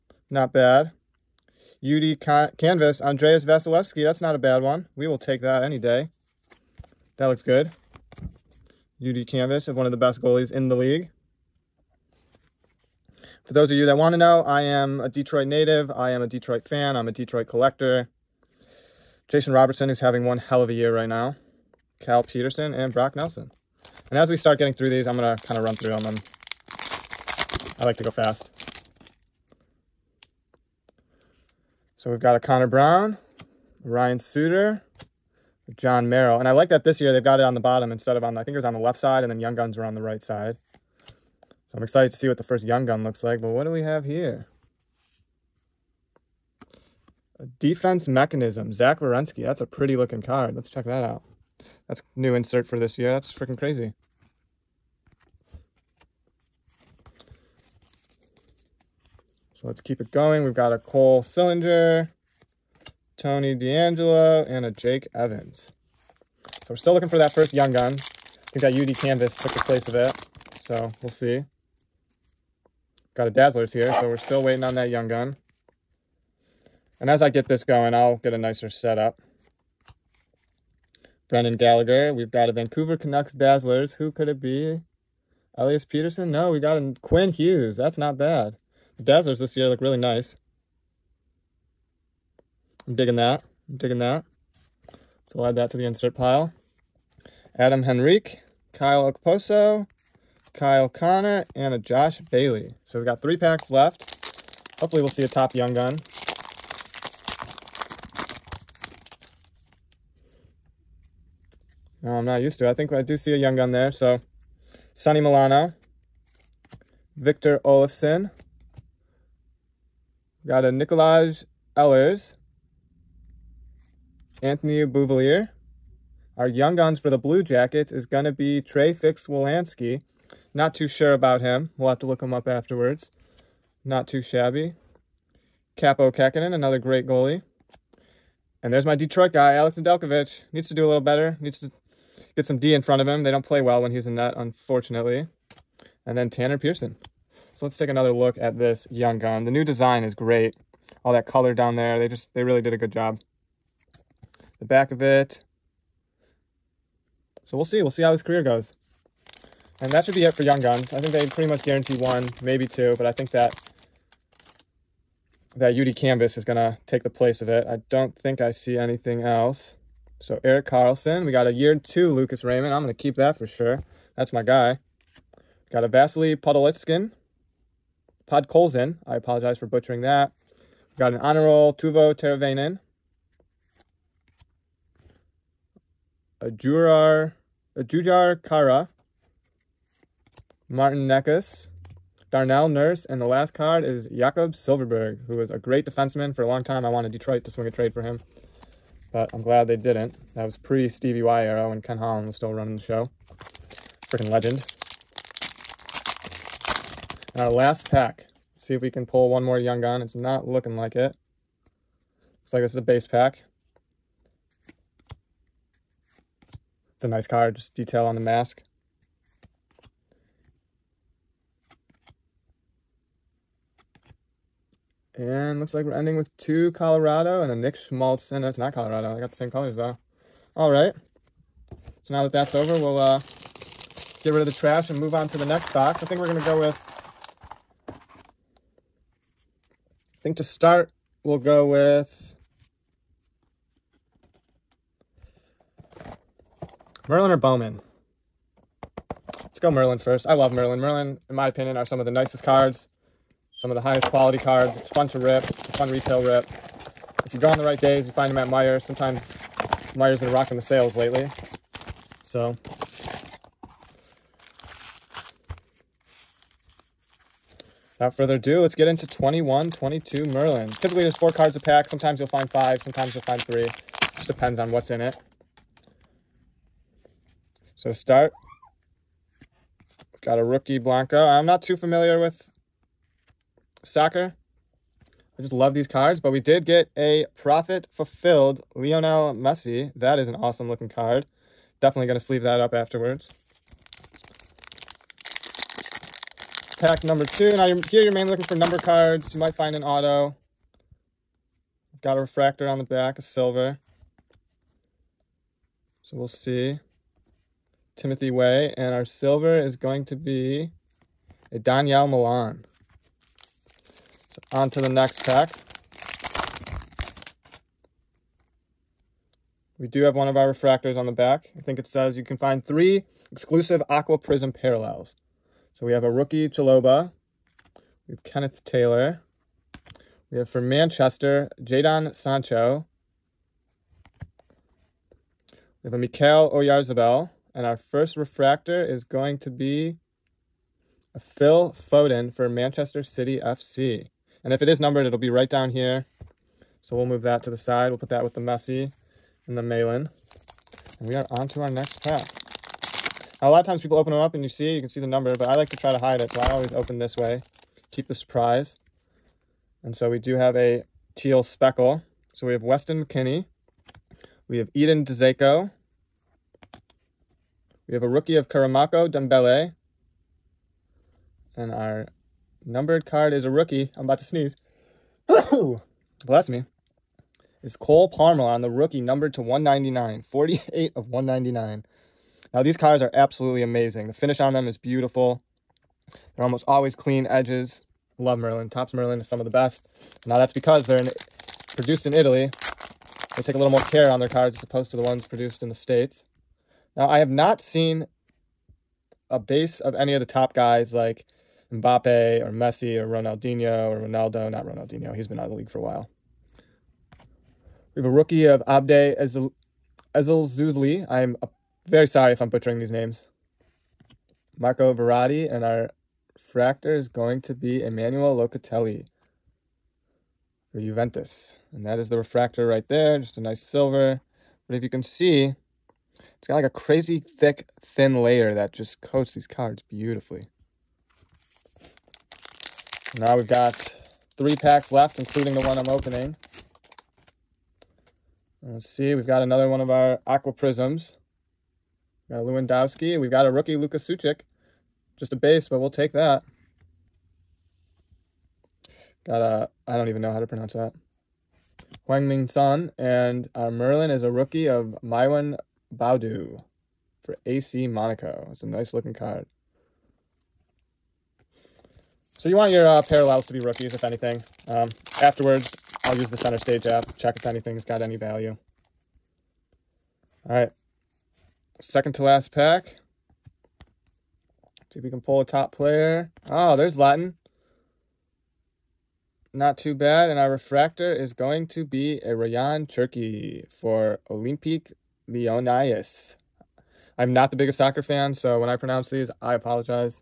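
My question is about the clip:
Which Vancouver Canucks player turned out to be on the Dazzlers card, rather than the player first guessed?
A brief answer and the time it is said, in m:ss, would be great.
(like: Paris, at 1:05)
Quinn Hughes, at 1:27.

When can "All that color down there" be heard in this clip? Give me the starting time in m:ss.
2:31.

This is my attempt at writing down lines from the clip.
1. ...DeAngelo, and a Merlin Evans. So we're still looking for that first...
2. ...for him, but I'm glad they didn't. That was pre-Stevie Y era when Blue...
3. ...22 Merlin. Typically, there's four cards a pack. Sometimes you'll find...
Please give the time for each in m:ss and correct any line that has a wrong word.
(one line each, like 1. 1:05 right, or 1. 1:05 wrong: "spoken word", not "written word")
1. 1:03 wrong: "Jake", not "Merlin"
2. 3:17 wrong: "Ken", not "Blue"
3. 4:29 right.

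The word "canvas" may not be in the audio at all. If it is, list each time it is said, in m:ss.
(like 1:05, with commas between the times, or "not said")
0:02, 0:09, 1:09, 2:45.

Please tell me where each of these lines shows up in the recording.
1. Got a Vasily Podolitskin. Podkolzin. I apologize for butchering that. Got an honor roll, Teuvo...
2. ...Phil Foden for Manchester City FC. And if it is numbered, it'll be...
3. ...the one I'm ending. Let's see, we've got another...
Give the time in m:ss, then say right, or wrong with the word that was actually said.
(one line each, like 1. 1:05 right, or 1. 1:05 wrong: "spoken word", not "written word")
1. 2:55 right
2. 5:41 right
3. 7:15 wrong: "opening", not "ending".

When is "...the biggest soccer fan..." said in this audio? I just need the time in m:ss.
8:07.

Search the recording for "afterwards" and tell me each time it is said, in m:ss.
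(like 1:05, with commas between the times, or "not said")
2:12, 4:52, 7:45.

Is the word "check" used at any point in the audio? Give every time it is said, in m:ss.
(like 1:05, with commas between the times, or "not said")
0:50, 7:47.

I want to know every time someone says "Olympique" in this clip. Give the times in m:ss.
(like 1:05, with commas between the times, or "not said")
8:04.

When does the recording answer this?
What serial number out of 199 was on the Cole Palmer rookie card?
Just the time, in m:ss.
6:20.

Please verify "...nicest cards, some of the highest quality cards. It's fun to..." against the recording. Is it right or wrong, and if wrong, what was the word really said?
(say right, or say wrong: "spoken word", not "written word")
right.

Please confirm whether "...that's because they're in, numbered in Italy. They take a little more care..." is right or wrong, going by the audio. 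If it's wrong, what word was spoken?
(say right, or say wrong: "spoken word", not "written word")
wrong: "produced", not "numbered".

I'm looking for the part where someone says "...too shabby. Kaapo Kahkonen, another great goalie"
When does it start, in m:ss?
2:14.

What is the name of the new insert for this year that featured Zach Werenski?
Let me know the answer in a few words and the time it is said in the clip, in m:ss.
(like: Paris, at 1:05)
Defense Mechanism, at 0:47.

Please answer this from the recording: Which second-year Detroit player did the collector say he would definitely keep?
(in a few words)
Lucas Raymond.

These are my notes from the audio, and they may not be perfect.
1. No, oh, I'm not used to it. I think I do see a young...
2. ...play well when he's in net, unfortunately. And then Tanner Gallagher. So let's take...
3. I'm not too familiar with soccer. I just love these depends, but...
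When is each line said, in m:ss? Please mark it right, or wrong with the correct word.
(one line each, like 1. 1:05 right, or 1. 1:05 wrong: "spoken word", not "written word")
1. 1:52 right
2. 2:23 wrong: "Pearson", not "Gallagher"
3. 4:41 wrong: "cards", not "depends".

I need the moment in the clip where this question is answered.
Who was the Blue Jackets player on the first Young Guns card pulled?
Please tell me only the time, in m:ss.
2:08.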